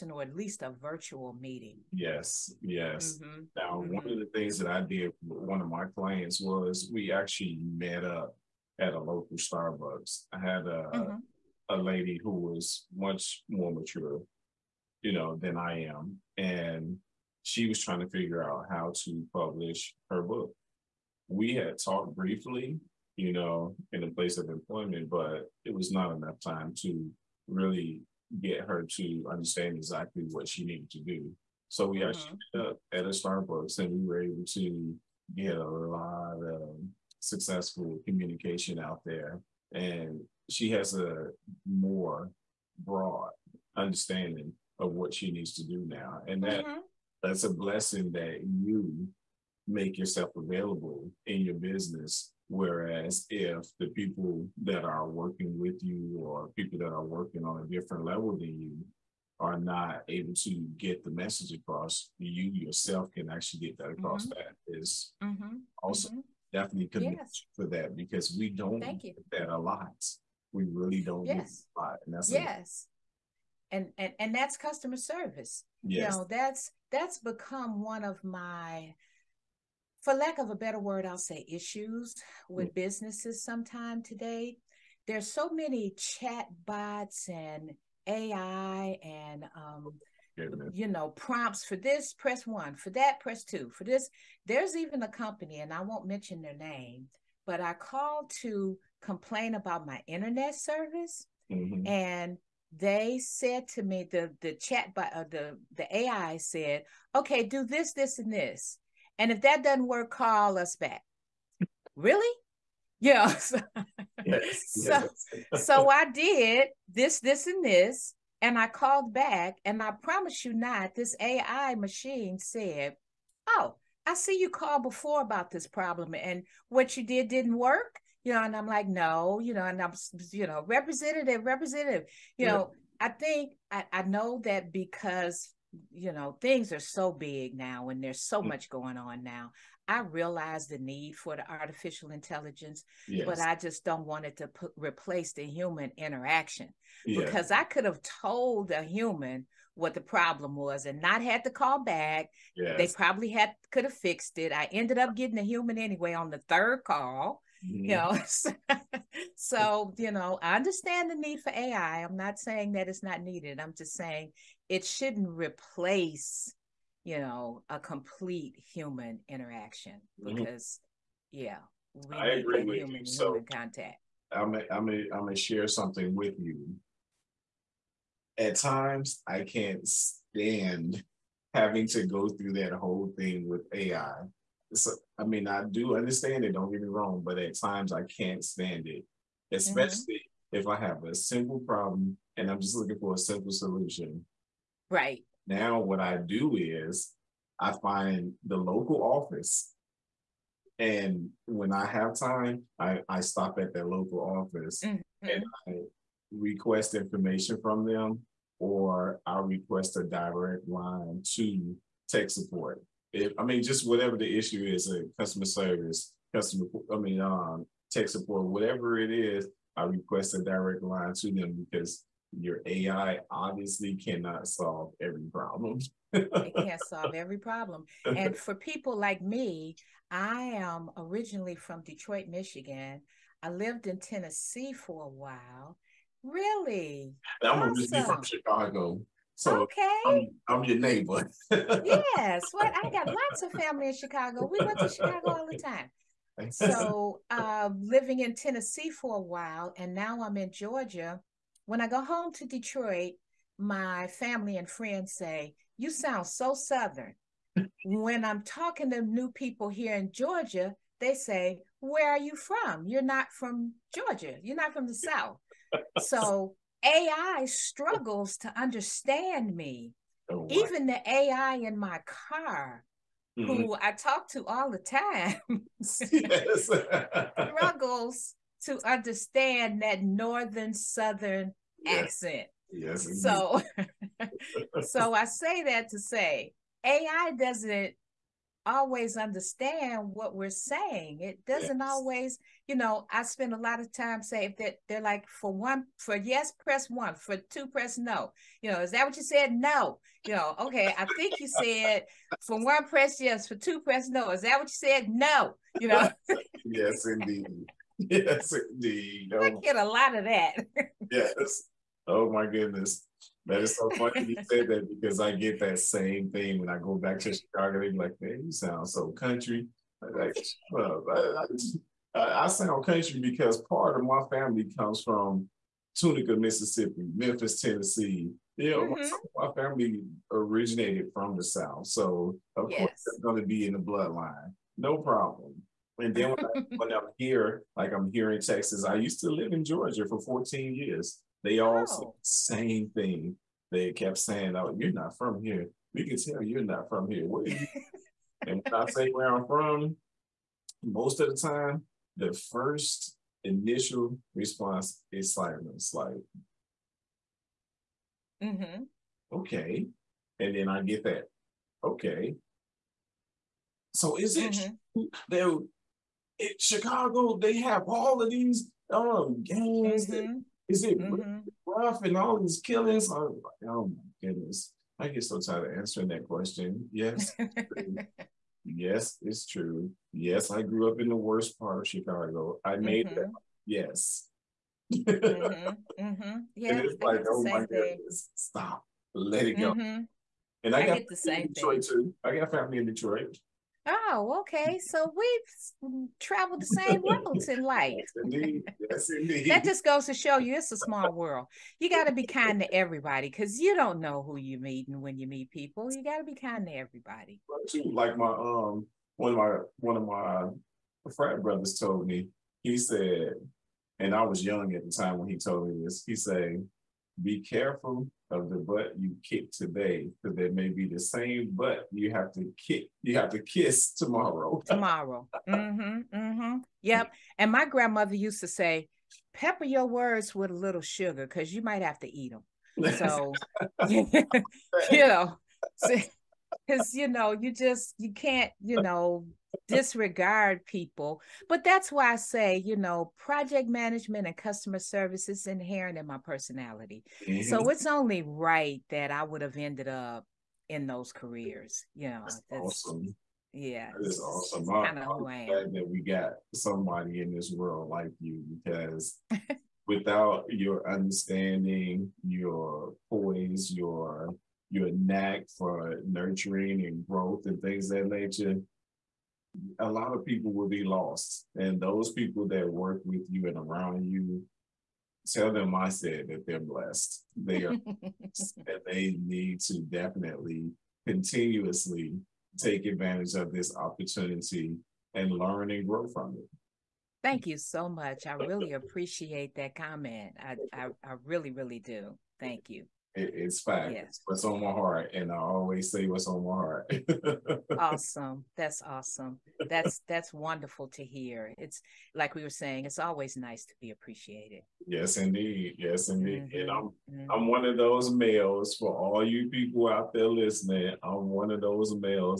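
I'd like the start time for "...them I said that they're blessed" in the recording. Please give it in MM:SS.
07:55.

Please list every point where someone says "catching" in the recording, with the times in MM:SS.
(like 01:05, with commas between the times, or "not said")
not said.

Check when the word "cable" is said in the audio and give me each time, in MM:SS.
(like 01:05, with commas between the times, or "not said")
not said.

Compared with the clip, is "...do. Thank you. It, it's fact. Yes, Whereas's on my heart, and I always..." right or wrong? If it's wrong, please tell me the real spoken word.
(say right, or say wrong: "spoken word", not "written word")
wrong: "What", not "Whereas".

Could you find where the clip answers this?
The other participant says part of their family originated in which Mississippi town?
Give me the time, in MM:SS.
05:25.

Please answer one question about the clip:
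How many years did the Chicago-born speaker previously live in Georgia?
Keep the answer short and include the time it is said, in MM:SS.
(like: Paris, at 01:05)
14, at 05:40.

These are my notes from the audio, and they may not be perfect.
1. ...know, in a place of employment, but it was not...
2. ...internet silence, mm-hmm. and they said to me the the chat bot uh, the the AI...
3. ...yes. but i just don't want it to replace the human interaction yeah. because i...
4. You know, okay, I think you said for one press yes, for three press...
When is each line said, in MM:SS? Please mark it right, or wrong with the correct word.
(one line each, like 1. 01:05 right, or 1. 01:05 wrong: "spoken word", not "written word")
1. 00:23 right
2. 01:40 wrong: "service", not "silence"
3. 02:23 right
4. 05:00 wrong: "two", not "three".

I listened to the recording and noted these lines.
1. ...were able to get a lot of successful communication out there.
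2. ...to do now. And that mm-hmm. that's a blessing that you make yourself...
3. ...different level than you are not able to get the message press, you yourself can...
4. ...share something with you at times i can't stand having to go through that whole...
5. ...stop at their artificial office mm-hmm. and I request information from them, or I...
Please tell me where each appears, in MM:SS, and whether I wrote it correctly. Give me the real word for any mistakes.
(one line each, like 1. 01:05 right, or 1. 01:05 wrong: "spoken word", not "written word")
1. 00:34 right
2. 00:45 right
3. 00:57 wrong: "across", not "press"
4. 02:55 right
5. 03:23 wrong: "local", not "artificial".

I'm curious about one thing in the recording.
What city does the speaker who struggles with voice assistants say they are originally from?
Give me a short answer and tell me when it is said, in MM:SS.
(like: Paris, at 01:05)
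Detroit, Michigan, at 03:51.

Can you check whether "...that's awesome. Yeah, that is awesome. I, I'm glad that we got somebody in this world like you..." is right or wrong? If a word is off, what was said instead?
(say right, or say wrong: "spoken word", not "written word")
right.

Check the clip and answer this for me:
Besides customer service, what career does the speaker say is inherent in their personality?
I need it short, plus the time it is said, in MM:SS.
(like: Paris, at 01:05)
project management, at 07:23.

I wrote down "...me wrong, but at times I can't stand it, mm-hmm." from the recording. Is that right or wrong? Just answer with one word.
right.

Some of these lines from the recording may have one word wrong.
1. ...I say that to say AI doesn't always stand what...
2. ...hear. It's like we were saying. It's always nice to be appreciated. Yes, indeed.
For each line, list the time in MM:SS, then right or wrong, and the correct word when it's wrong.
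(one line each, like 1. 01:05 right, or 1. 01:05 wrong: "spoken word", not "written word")
1. 04:45 wrong: "understand", not "stand"
2. 08:21 right.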